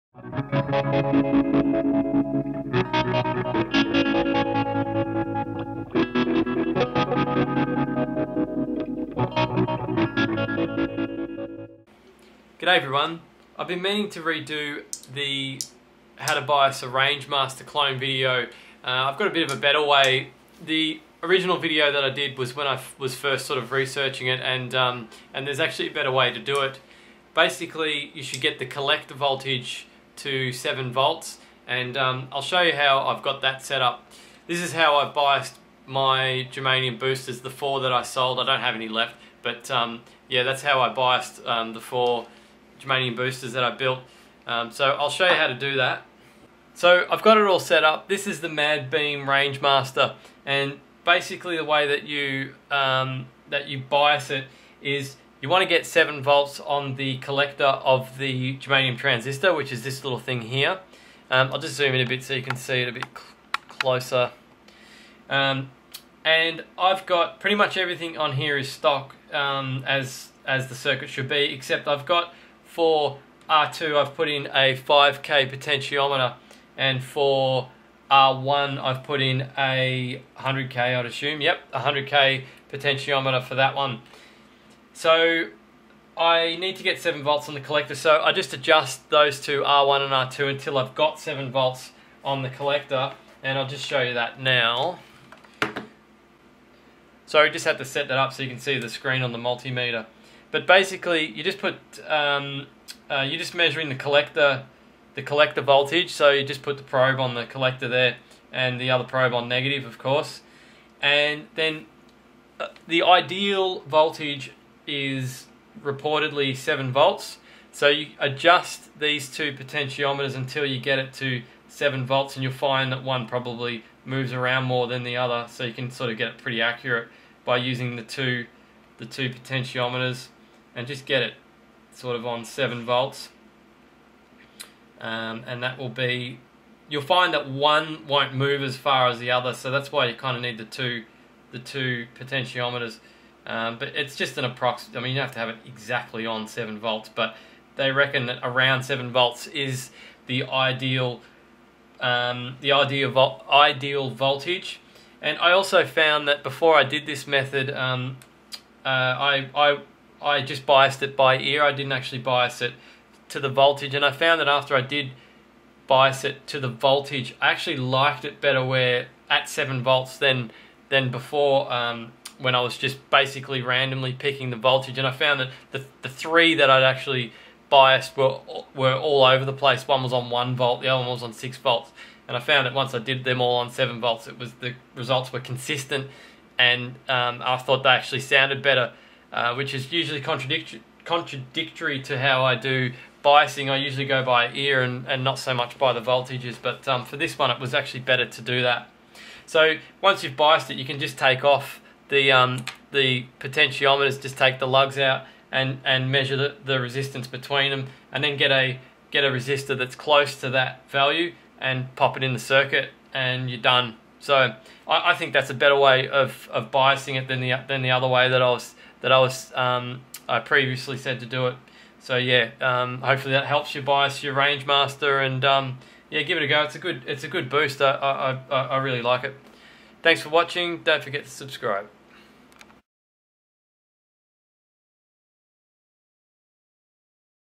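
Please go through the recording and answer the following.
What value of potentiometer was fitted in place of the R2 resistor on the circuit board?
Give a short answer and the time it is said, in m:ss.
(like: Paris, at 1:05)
5K, at 1:14.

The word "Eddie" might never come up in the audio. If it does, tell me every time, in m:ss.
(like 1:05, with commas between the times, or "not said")
not said.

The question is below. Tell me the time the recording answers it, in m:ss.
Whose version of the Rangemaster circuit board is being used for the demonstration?
0:48.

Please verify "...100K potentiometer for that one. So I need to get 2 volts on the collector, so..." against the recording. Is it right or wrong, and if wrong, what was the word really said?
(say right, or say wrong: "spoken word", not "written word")
wrong: "7", not "2".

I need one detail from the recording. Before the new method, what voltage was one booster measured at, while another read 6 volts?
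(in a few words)
1 volt.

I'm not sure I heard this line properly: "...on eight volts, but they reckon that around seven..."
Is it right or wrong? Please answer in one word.
wrong.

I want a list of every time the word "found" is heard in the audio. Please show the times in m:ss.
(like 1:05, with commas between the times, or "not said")
2:35, 2:44, 2:55, 3:02.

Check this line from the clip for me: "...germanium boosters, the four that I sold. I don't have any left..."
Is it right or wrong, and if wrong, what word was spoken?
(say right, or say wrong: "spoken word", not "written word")
right.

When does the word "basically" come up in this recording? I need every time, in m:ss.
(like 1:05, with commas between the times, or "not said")
0:27, 0:51, 1:40, 2:53.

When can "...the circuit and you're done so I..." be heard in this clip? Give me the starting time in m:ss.
3:32.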